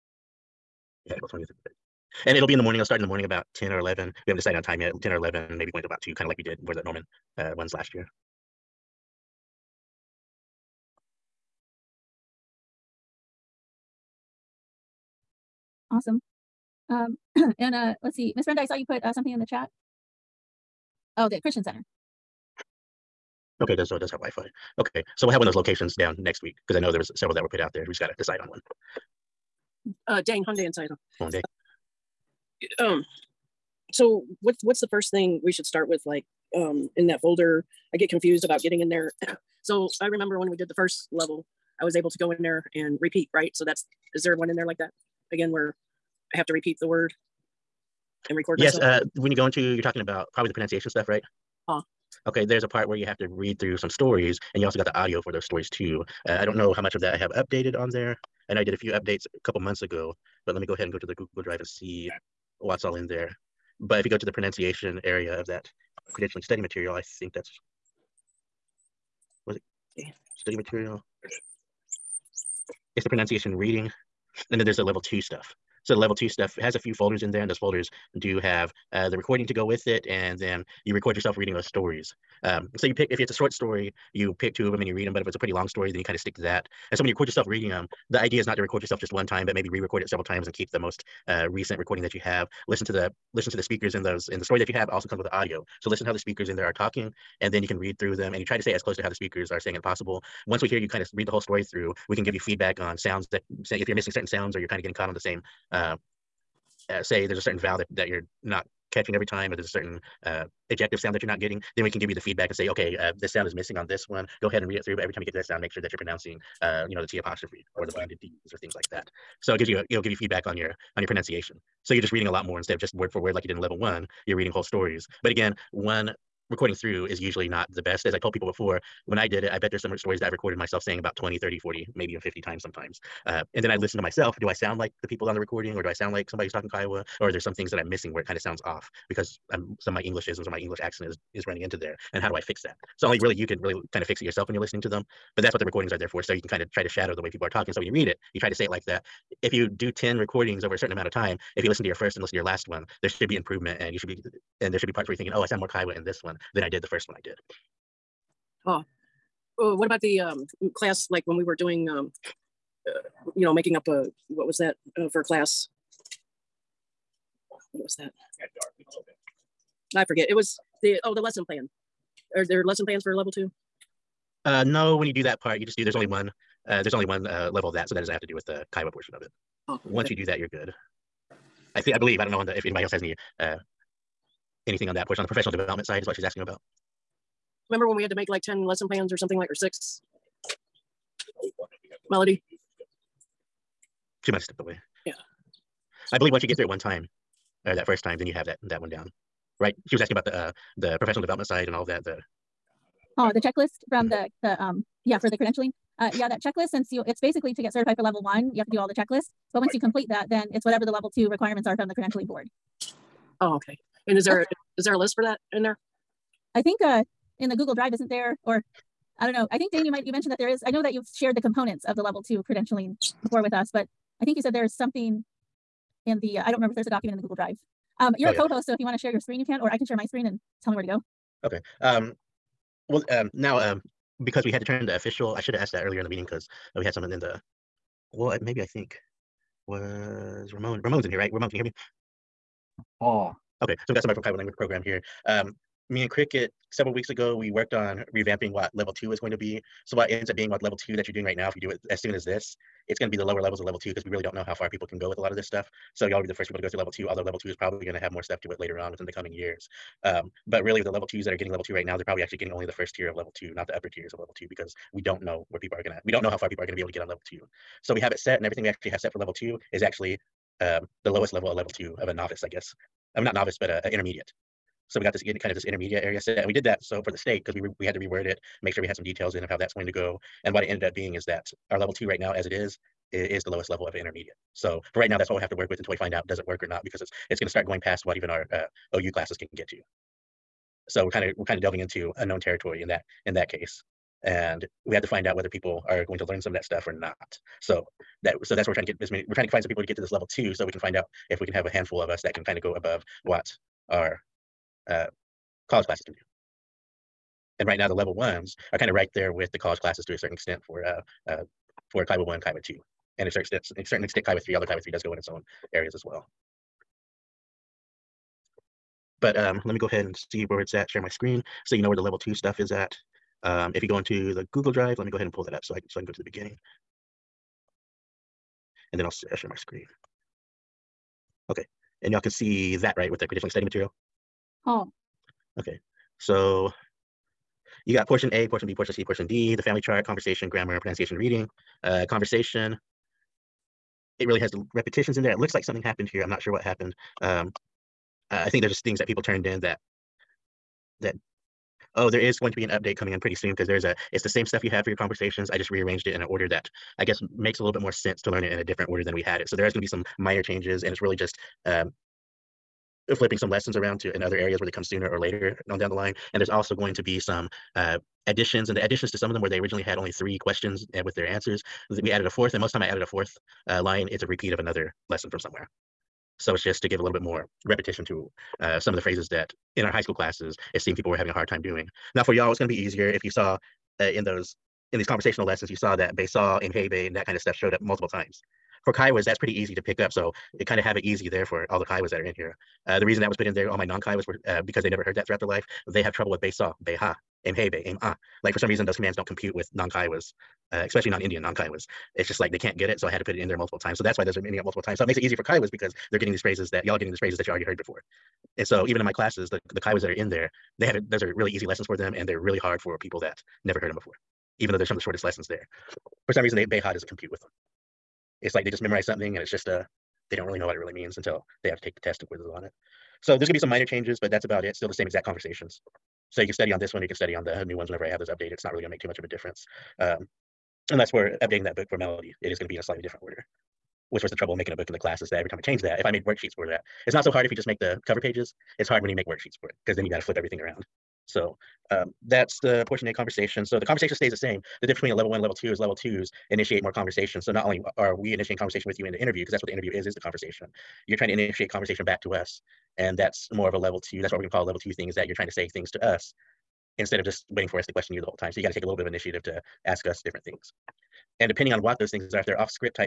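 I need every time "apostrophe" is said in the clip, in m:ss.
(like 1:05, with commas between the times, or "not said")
1:57.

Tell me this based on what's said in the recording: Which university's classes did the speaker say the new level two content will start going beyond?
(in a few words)
OU.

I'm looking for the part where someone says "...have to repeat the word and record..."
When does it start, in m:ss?
0:46.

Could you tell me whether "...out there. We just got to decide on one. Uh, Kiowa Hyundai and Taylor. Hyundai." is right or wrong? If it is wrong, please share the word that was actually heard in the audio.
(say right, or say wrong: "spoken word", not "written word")
wrong: "Dane", not "Kiowa".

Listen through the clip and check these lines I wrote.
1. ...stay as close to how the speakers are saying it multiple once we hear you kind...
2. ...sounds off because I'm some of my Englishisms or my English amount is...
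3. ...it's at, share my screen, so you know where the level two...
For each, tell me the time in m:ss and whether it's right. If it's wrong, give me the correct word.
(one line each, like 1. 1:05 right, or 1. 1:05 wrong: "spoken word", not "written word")
1. 1:38 wrong: "possible", not "multiple"
2. 2:18 wrong: "accent", not "amount"
3. 5:20 right.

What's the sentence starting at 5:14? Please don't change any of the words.
Although Kiowa three does go in its own areas as well.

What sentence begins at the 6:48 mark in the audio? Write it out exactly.
And so even in my classes, the the Kiowas that are in there, they have it.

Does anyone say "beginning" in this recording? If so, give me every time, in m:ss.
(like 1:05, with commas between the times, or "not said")
5:26.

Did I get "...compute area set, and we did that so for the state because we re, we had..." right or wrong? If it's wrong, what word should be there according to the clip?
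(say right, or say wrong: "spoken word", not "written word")
wrong: "intermediate", not "compute".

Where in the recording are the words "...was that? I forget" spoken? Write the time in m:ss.
2:47.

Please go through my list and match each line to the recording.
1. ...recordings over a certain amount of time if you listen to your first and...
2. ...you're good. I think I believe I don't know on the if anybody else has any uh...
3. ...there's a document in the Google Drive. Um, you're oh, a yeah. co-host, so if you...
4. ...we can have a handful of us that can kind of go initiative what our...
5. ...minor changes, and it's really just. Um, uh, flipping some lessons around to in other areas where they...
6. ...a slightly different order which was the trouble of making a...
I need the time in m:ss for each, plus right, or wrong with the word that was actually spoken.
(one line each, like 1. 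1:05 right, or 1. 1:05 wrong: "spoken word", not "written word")
1. 2:30 right
2. 3:00 right
3. 3:46 right
4. 5:01 wrong: "above", not "initiative"
5. 6:00 right
6. 7:12 right.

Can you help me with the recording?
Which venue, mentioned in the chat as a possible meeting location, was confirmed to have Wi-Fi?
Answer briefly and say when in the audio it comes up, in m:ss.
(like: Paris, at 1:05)
Christian Center, at 0:21.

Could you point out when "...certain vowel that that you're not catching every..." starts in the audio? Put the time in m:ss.
1:47.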